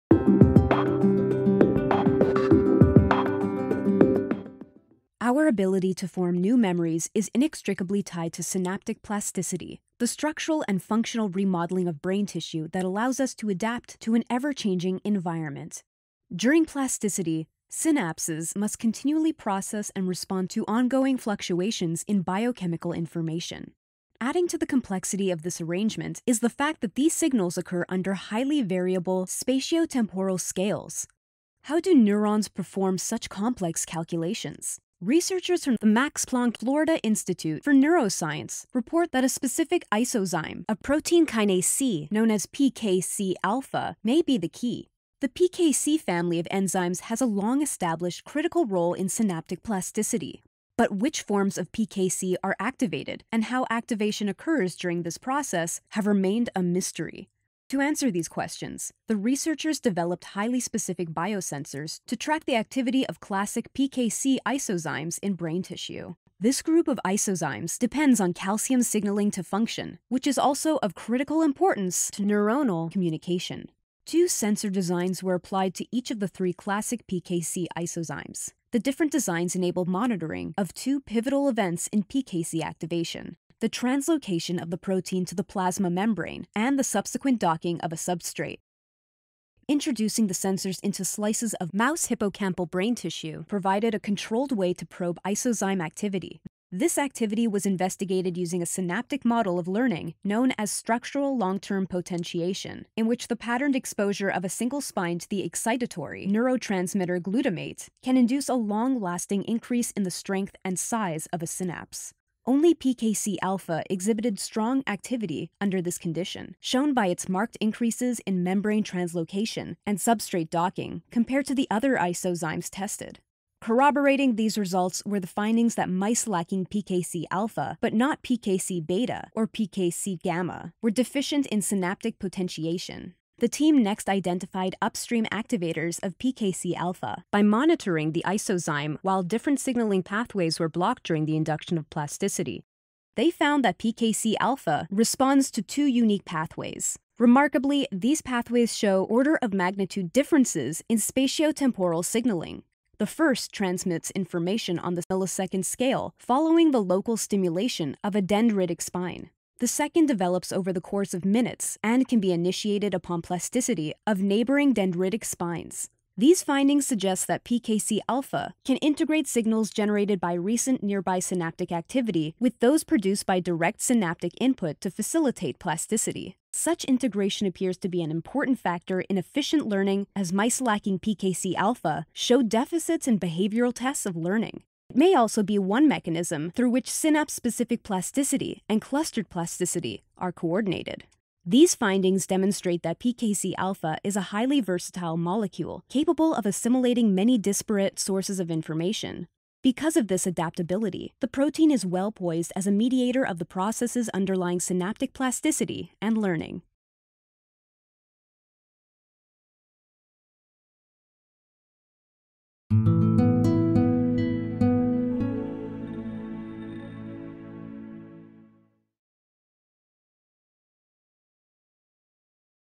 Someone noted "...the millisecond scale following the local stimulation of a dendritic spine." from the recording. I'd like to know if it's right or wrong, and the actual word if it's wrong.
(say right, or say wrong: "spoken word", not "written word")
right.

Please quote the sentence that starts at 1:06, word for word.
This group of isozymes depends on calcium signaling to function, which is also of critical importance to neuronal communication.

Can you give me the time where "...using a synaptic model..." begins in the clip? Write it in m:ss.
1:38.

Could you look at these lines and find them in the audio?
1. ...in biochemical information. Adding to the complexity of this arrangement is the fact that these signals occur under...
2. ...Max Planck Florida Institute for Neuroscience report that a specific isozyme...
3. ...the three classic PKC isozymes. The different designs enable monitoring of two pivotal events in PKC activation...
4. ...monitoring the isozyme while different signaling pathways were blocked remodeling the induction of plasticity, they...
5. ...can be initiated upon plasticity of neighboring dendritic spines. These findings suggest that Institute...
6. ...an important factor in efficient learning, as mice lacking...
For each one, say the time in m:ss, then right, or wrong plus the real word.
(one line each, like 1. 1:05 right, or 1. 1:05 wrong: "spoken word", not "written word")
1. 0:22 right
2. 0:35 right
3. 1:16 right
4. 2:17 wrong: "during", not "remodeling"
5. 2:42 wrong: "PKC", not "Institute"
6. 2:58 right.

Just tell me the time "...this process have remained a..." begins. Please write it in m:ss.
0:55.